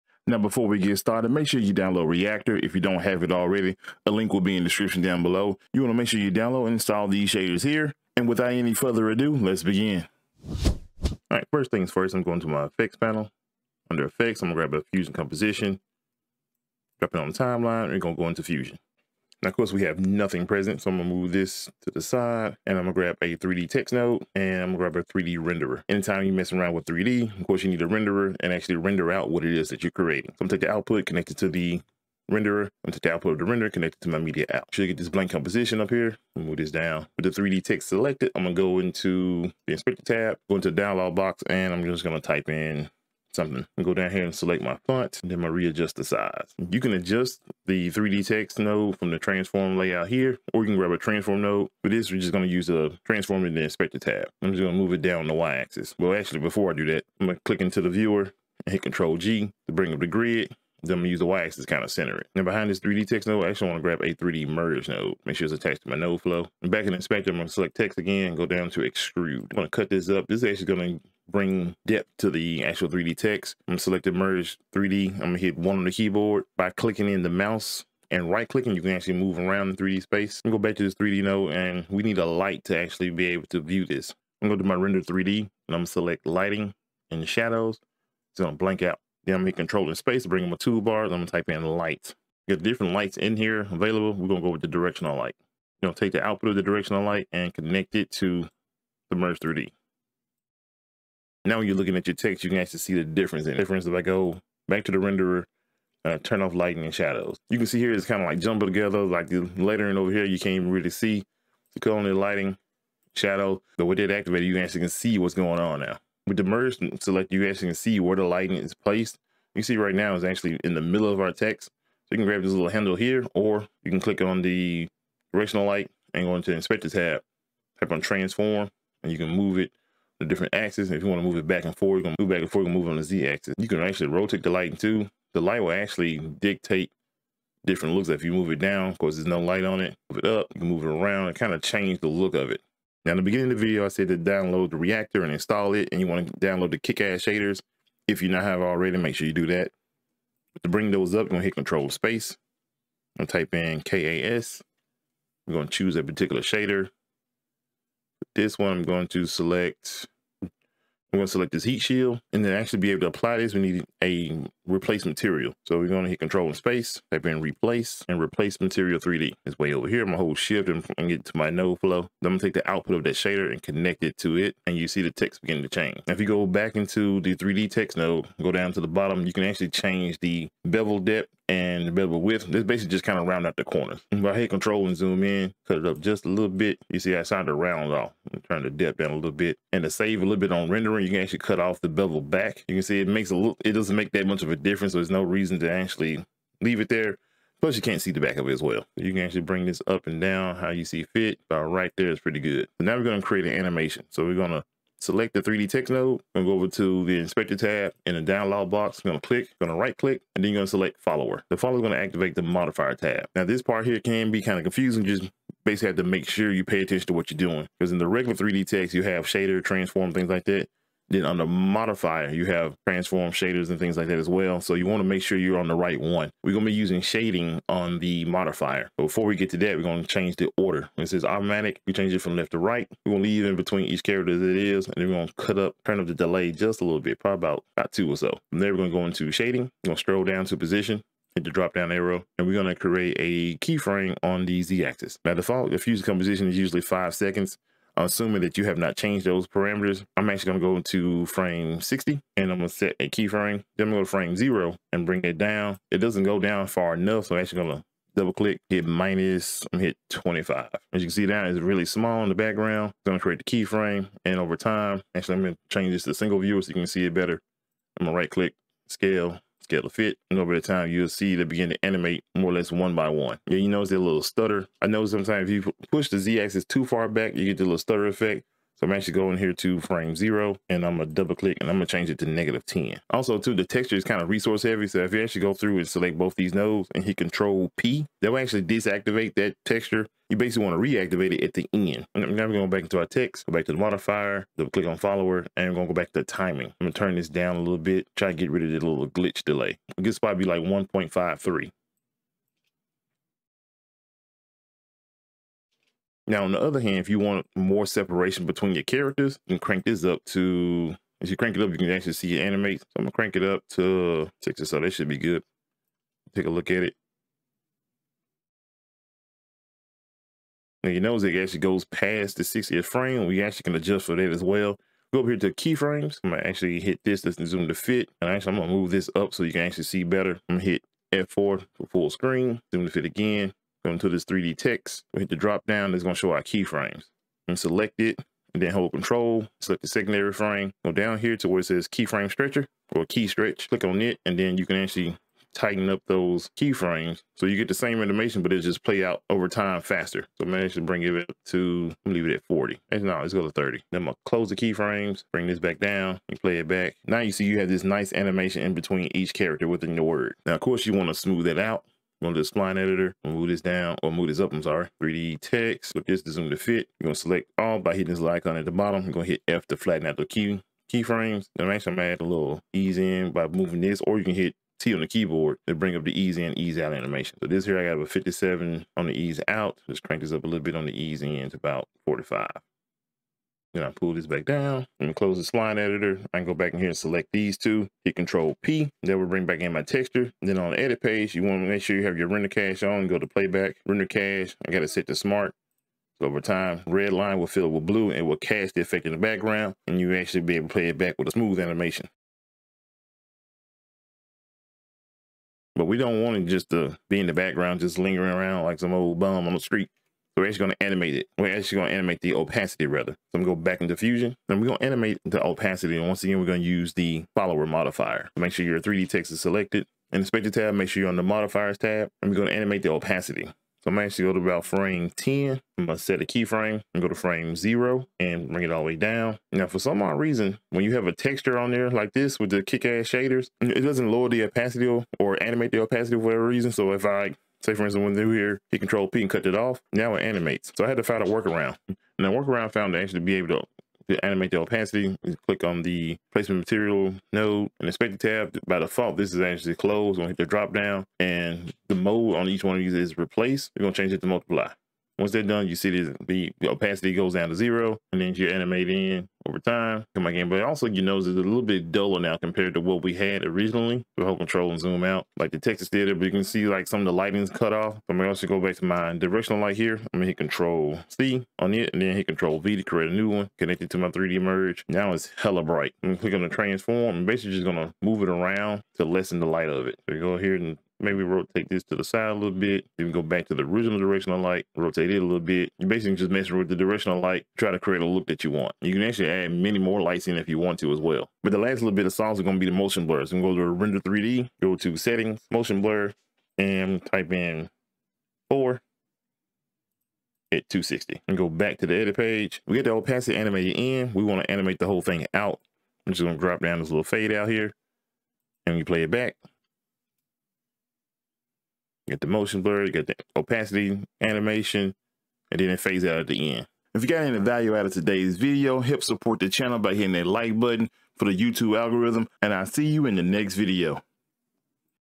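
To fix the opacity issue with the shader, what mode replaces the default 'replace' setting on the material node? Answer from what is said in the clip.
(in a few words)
Multiply.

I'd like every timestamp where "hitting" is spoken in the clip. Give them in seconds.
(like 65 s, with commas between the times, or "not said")
367 s, 519 s.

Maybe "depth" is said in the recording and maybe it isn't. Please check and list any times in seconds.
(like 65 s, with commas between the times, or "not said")
71 s, 180 s, 188 s.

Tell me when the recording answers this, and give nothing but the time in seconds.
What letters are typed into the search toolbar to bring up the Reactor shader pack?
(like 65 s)
153 s.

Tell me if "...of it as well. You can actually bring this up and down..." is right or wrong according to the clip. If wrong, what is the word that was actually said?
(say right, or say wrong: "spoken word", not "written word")
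right.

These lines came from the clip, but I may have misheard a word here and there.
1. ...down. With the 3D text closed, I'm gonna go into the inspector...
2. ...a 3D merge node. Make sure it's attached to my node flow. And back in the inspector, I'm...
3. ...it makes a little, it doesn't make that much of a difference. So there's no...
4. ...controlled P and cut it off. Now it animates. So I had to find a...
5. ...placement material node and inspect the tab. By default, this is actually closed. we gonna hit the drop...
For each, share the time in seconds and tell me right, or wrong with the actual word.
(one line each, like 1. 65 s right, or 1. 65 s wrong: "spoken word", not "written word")
1. 36 s wrong: "selected", not "closed"
2. 64 s right
3. 193 s right
4. 438 s right
5. 446 s right.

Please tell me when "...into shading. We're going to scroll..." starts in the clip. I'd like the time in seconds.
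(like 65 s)
239 s.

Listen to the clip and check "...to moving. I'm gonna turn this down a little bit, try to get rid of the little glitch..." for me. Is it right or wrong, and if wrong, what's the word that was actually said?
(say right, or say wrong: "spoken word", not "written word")
wrong: "timing", not "moving".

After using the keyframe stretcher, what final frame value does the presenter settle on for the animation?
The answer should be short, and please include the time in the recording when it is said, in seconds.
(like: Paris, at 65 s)
30, at 353 s.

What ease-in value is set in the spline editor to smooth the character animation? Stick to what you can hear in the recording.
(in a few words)
45.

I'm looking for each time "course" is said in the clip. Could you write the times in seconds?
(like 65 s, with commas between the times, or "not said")
19 s, 27 s, 138 s, 360 s.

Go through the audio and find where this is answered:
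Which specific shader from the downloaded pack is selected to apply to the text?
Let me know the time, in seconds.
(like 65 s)
161 s.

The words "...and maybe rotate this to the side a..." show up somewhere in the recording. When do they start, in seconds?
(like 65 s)
480 s.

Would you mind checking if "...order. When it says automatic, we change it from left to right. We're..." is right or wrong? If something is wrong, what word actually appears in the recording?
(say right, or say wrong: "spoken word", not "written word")
right.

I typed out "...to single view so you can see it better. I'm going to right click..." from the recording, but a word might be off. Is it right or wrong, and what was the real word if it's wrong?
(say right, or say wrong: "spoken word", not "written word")
right.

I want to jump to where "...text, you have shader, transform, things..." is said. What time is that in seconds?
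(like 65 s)
218 s.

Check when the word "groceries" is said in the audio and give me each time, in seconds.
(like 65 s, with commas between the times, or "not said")
not said.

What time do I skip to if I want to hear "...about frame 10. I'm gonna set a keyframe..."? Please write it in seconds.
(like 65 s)
424 s.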